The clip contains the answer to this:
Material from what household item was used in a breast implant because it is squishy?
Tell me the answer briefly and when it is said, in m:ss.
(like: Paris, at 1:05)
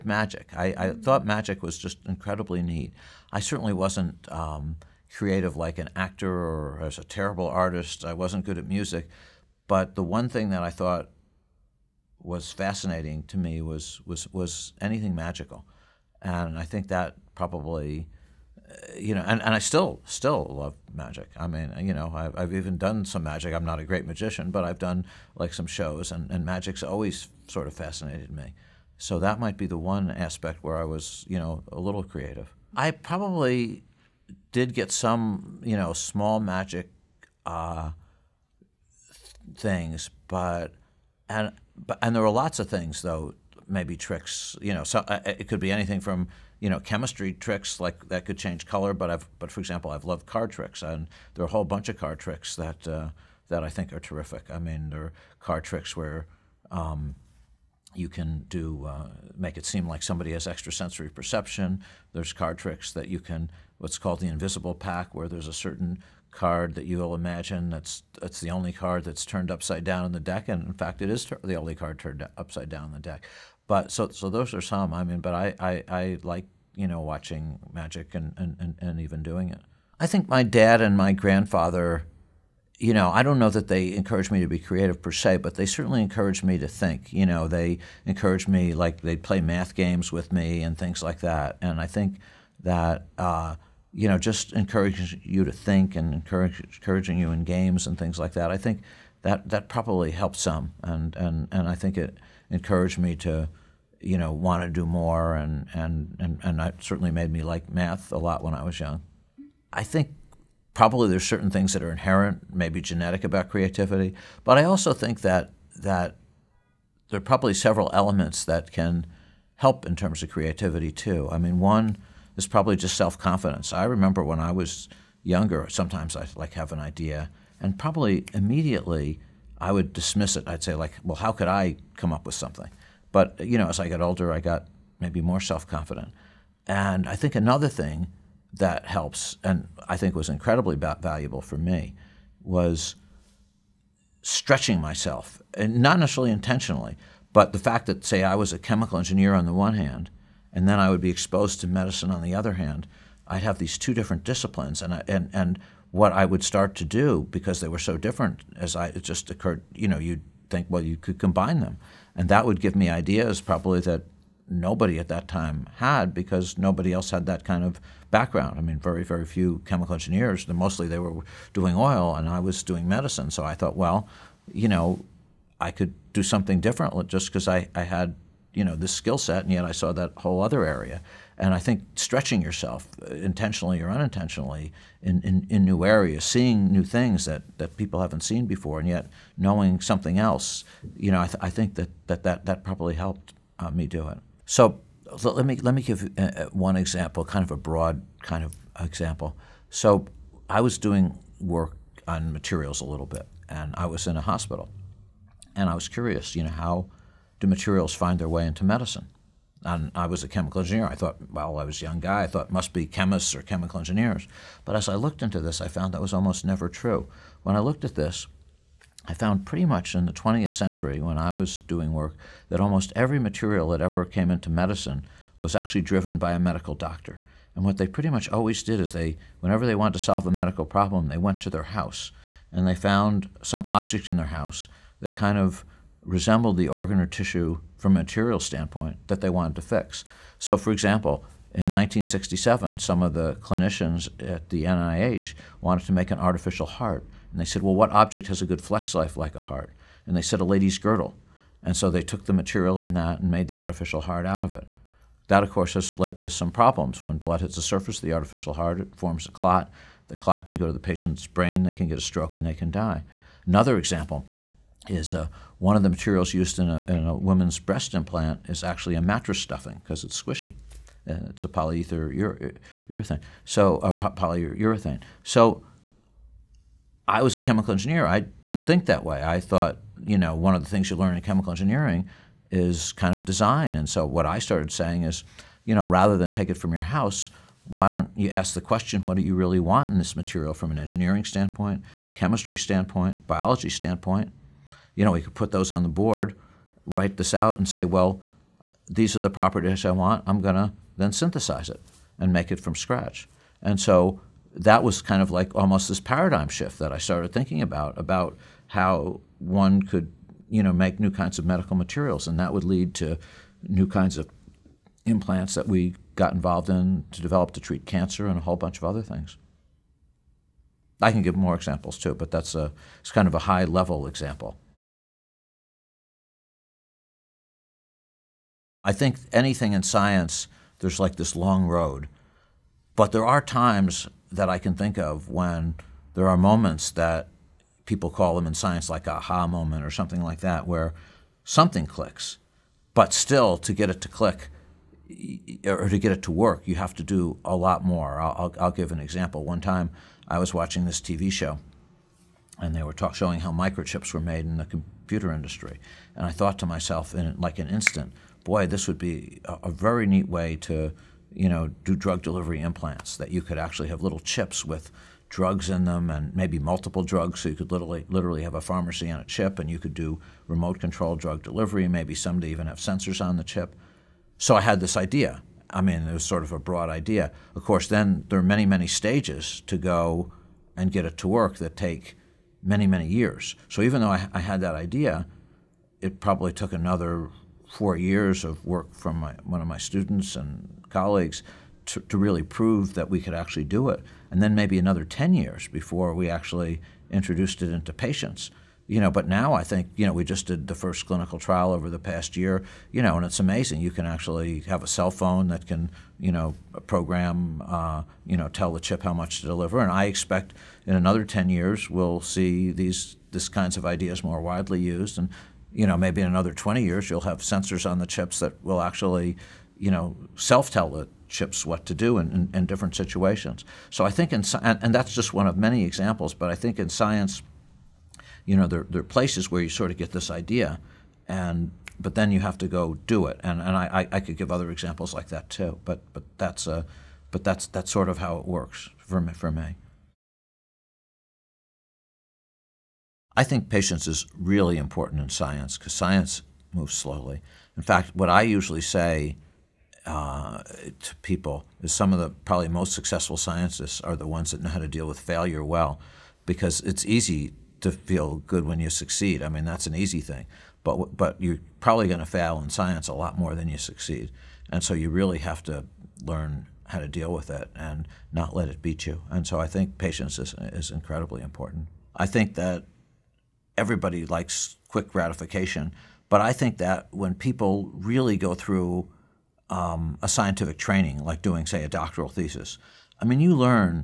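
mattress stuffing, at 4:28.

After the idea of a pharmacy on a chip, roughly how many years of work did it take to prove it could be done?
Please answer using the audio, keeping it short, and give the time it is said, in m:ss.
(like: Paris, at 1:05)
4, at 6:27.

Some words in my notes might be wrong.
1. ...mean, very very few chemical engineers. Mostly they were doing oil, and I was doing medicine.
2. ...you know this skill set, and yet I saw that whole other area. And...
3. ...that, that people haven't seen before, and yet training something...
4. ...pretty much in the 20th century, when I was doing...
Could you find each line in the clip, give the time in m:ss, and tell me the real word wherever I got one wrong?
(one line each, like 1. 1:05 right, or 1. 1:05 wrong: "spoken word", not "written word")
1. 2:48 right
2. 2:58 right
3. 3:07 wrong: "knowing", not "training"
4. 3:39 right.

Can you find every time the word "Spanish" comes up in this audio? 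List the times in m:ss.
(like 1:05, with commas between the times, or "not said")
not said.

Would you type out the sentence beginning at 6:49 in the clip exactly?
And I expect in another 10 years, we'll see these, these kinds of ideas more widely used.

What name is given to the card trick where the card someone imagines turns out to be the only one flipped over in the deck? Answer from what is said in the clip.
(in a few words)
the invisible pack.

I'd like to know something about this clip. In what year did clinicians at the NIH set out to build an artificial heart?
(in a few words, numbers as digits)
1967.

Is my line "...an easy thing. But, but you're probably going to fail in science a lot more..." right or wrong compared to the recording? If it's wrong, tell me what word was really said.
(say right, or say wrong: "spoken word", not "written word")
right.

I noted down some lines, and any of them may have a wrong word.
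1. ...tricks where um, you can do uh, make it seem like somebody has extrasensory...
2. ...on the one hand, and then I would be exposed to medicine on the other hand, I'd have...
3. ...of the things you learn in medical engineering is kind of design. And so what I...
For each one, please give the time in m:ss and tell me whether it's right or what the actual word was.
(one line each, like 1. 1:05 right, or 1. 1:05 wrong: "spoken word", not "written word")
1. 0:55 right
2. 2:29 right
3. 4:40 wrong: "chemical", not "medical".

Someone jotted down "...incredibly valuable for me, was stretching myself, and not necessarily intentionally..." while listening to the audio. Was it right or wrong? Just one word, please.
right.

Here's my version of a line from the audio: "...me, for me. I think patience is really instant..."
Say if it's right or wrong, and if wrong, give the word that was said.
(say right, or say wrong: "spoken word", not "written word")
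wrong: "important", not "instant".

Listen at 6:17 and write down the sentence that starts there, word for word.
Of course, then there are many, many stages to go and get it to work that take many, many years.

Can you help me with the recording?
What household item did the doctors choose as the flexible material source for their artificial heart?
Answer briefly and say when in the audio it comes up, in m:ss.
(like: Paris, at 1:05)
a lady's girdle, at 4:10.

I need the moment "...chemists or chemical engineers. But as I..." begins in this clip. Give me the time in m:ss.
3:32.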